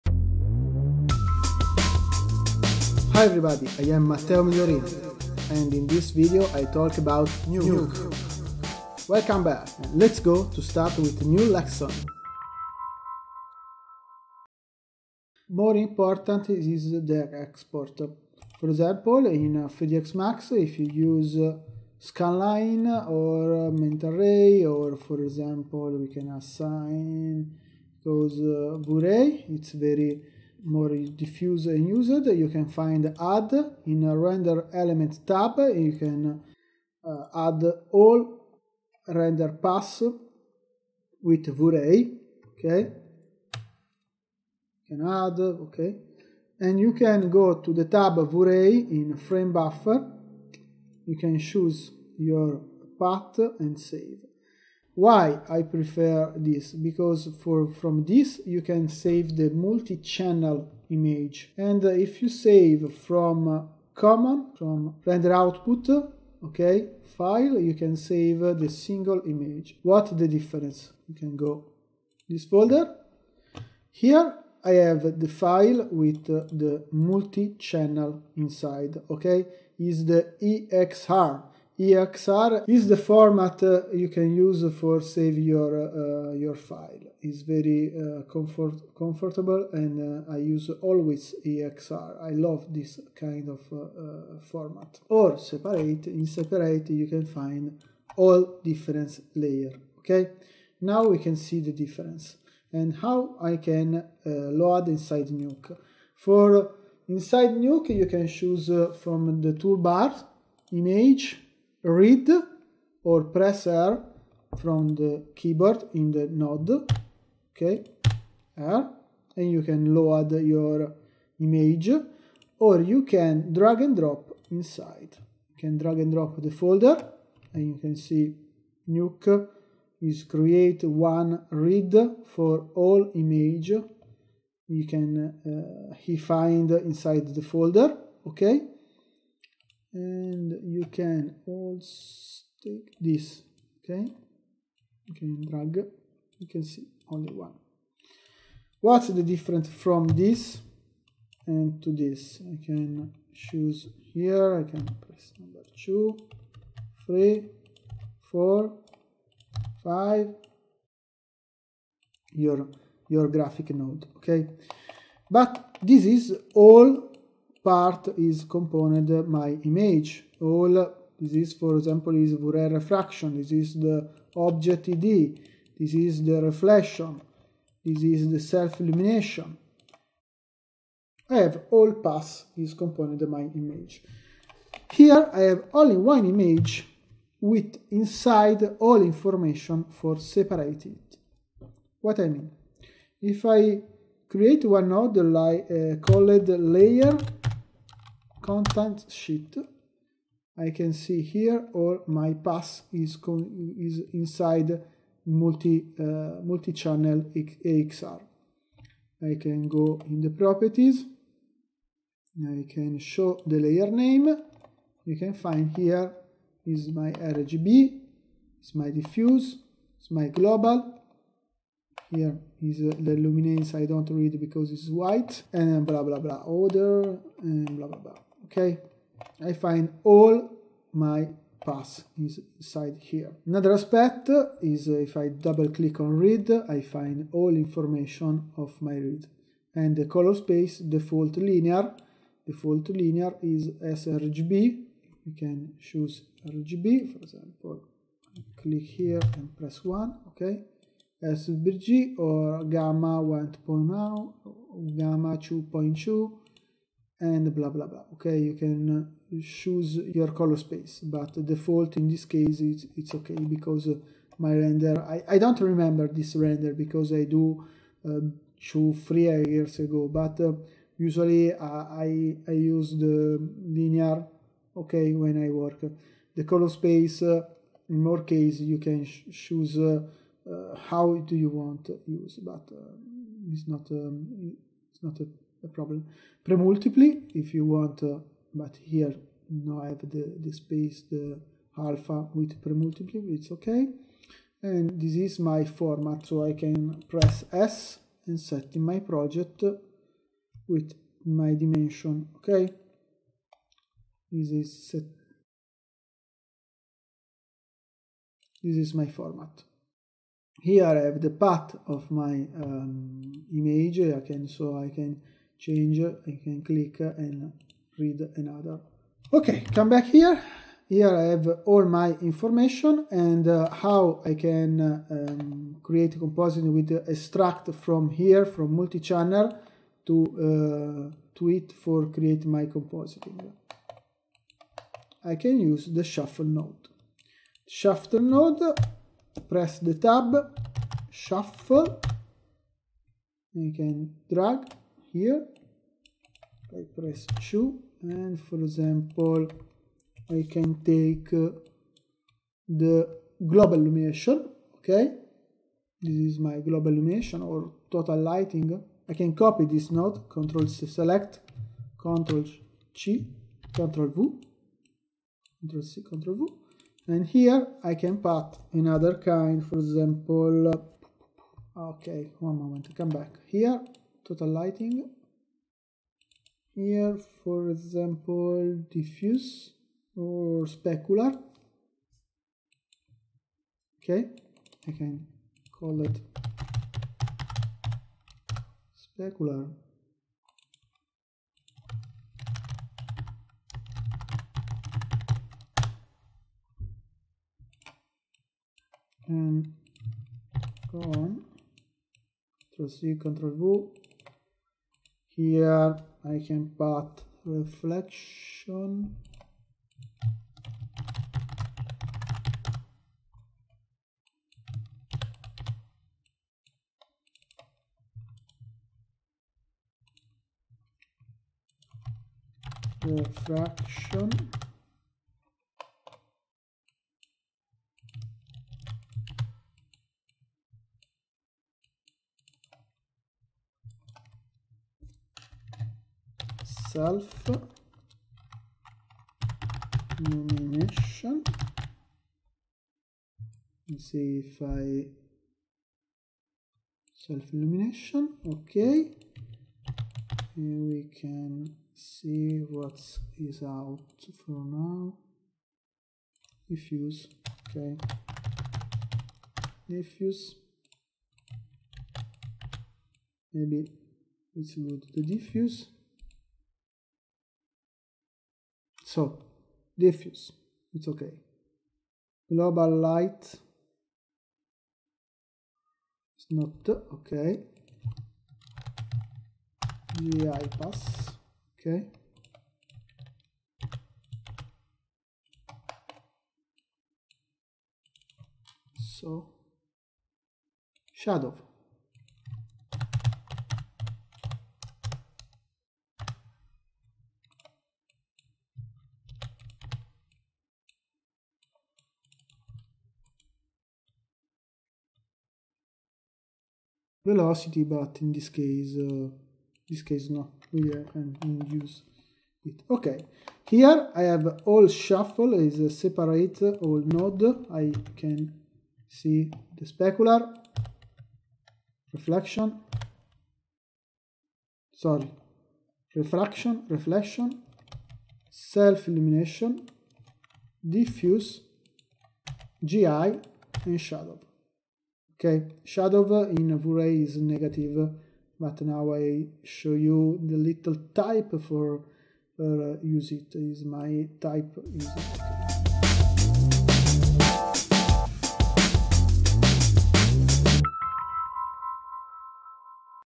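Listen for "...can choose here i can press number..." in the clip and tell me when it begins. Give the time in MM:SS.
02:32.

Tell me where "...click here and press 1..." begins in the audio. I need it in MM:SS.
04:08.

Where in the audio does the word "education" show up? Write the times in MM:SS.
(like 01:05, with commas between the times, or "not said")
not said.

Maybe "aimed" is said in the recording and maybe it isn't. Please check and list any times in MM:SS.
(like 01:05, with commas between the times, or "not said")
not said.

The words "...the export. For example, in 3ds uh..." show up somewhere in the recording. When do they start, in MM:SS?
00:16.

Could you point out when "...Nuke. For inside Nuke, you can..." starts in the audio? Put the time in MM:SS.
01:45.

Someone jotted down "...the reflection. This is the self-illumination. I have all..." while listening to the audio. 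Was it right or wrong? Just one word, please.
right.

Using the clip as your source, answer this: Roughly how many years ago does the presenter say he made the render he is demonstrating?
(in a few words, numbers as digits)
2 to 3 years.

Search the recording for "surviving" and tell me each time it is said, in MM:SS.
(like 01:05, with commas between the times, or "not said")
not said.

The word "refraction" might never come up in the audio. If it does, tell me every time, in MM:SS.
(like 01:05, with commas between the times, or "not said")
02:52, 08:46.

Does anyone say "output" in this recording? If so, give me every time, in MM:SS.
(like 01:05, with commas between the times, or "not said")
01:05.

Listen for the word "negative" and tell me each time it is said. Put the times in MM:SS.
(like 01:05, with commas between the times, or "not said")
08:57.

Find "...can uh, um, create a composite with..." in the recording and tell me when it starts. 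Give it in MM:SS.
05:24.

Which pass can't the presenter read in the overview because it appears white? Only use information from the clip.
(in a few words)
luminance.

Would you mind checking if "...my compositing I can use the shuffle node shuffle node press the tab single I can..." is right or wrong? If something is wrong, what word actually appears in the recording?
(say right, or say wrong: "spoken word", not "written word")
wrong: "shuffle", not "single".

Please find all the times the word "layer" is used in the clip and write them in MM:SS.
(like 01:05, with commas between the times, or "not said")
01:39, 03:16, 03:33.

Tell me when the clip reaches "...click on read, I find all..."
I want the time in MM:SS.
03:55.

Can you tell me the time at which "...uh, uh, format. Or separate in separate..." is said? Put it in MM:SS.
01:33.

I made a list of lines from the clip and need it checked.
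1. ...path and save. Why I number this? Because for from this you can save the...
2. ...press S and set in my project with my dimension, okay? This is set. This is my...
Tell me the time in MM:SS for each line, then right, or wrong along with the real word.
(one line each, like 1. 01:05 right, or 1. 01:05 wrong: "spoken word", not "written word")
1. 00:52 wrong: "prefer", not "number"
2. 04:57 right.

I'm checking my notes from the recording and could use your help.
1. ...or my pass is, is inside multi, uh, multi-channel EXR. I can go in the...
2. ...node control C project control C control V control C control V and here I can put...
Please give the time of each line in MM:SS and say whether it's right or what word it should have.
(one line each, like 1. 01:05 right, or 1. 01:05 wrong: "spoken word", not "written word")
1. 03:21 right
2. 05:59 wrong: "select", not "project".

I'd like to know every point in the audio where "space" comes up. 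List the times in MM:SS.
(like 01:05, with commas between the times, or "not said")
04:00, 04:20, 04:36, 04:50.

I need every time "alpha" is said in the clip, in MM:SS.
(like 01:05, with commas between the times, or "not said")
04:51.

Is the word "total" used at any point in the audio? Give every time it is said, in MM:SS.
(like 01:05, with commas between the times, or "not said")
05:57, 06:14.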